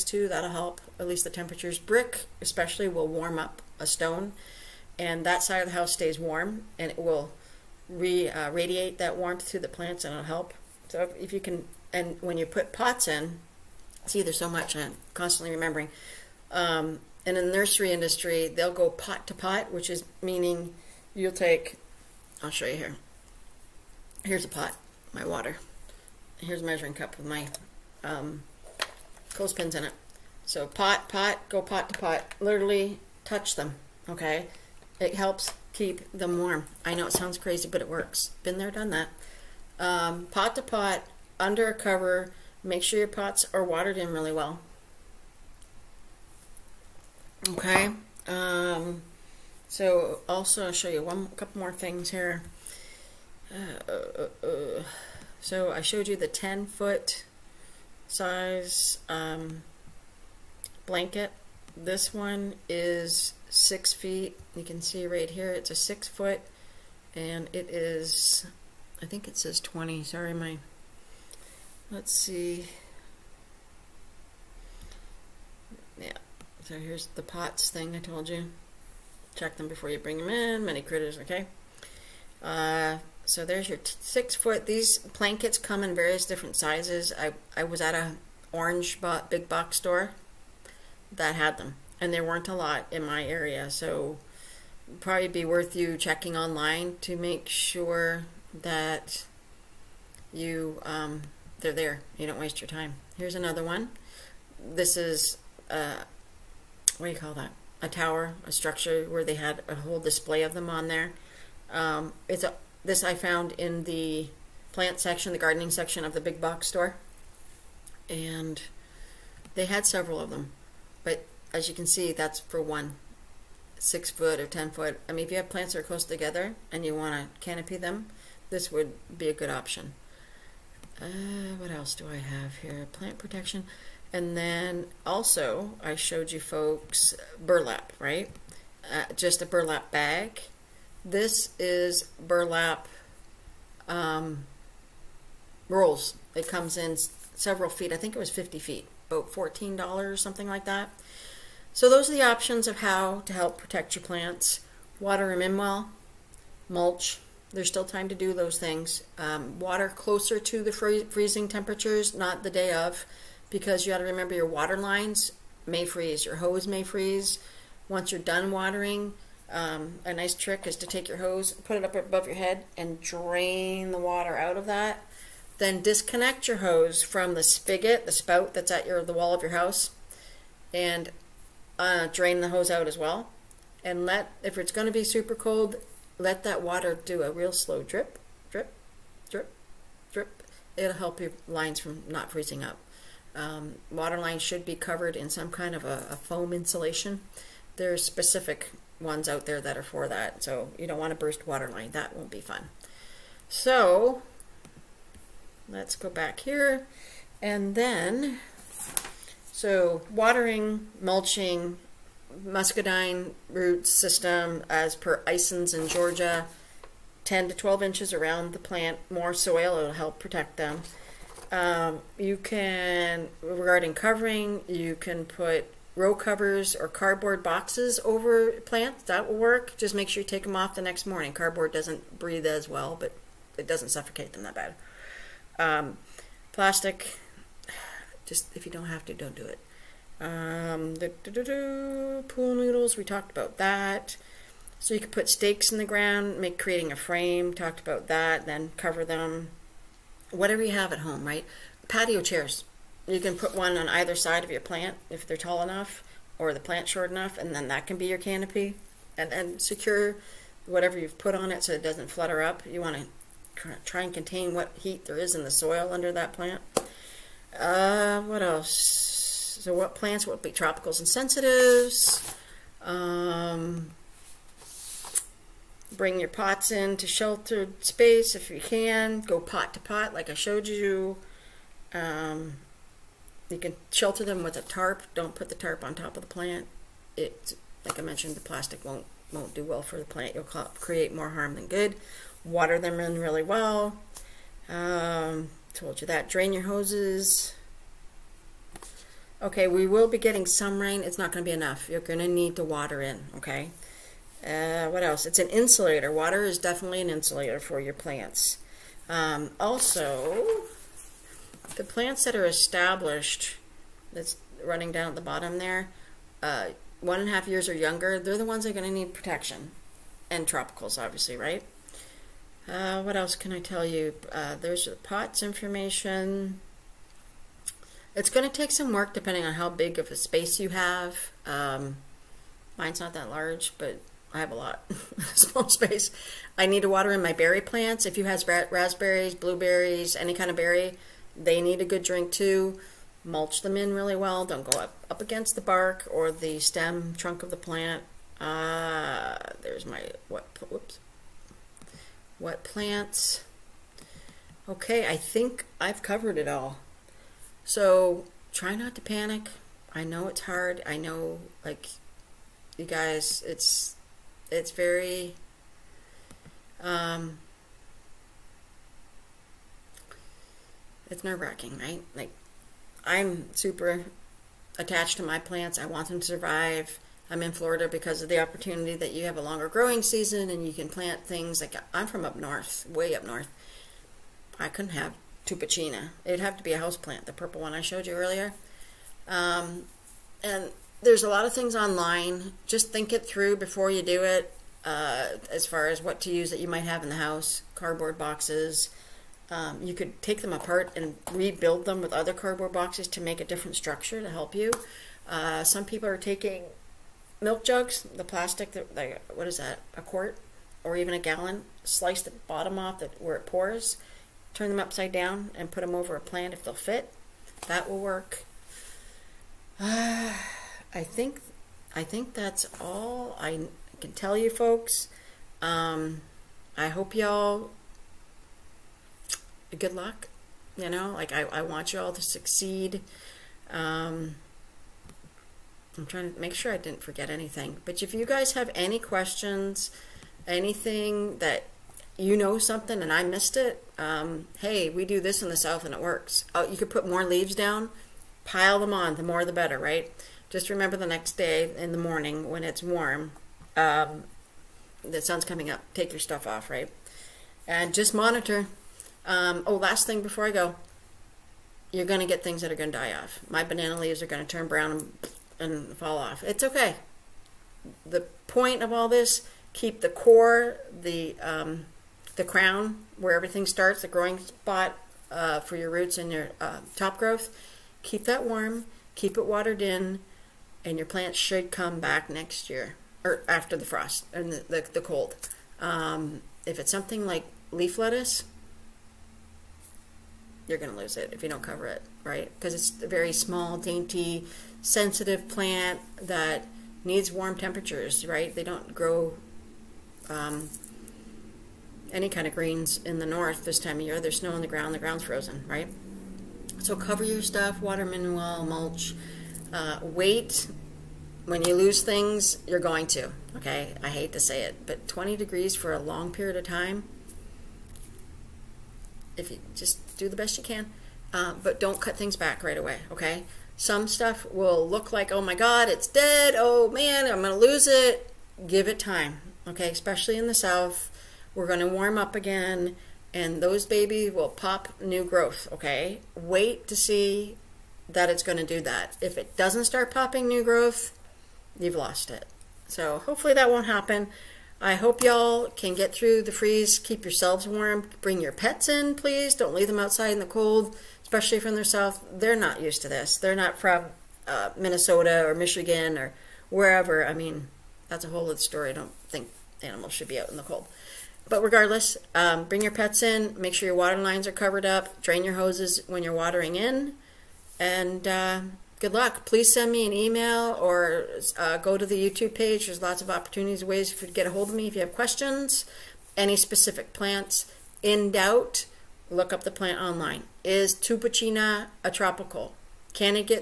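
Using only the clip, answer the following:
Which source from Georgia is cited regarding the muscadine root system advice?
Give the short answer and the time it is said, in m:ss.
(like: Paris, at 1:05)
Isons, at 3:35.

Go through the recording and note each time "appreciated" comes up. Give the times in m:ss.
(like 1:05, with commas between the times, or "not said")
not said.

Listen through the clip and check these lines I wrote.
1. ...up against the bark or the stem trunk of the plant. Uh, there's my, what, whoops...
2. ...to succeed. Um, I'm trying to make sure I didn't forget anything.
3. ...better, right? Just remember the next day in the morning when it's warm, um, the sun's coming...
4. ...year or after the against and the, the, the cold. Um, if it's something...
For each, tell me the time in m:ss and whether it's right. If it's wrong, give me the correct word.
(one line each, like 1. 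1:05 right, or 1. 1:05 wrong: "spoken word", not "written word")
1. 5:45 right
2. 7:12 right
3. 7:29 right
4. 8:02 wrong: "frost", not "against".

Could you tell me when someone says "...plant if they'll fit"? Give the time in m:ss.
6:56.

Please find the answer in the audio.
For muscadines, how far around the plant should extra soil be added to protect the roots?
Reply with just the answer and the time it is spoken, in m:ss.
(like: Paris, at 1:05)
10 to 12 inches, at 3:37.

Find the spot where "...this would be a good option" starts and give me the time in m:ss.
2:08.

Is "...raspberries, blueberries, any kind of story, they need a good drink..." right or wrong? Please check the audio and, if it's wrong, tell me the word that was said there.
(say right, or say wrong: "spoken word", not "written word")
wrong: "berry", not "story".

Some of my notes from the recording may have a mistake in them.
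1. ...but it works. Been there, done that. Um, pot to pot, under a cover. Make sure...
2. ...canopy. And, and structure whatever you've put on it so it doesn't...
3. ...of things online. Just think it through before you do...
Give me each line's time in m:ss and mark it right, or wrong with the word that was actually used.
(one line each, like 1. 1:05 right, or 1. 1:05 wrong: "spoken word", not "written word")
1. 0:37 right
2. 4:18 wrong: "secure", not "structure"
3. 6:31 right.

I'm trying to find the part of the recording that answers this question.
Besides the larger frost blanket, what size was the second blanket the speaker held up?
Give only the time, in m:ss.
1:03.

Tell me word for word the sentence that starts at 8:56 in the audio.
Wait to see that it's going to do that.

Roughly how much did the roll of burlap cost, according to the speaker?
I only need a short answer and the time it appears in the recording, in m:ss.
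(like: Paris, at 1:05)
$14, at 2:29.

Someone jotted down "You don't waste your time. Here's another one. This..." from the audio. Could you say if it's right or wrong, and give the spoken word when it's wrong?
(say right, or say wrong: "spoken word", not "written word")
right.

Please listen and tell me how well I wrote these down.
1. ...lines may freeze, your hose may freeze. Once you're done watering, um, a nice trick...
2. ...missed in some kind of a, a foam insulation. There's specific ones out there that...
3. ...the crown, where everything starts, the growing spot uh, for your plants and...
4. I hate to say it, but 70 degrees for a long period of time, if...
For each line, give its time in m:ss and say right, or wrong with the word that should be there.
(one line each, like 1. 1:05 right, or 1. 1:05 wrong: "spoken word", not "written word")
1. 2:44 right
2. 3:14 wrong: "covered", not "missed"
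3. 7:52 wrong: "roots", not "plants"
4. 8:34 wrong: "20", not "70".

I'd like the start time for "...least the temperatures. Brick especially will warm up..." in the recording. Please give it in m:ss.
0:01.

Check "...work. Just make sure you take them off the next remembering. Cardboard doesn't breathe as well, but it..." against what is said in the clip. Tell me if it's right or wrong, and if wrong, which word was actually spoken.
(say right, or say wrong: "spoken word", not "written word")
wrong: "morning", not "remembering".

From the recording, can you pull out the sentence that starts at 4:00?
Um, da, pool noodles, we talked about that.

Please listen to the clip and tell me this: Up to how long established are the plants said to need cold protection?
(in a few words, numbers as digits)
1.5 years.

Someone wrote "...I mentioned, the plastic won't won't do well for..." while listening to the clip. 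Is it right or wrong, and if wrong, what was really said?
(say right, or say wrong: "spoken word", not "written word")
right.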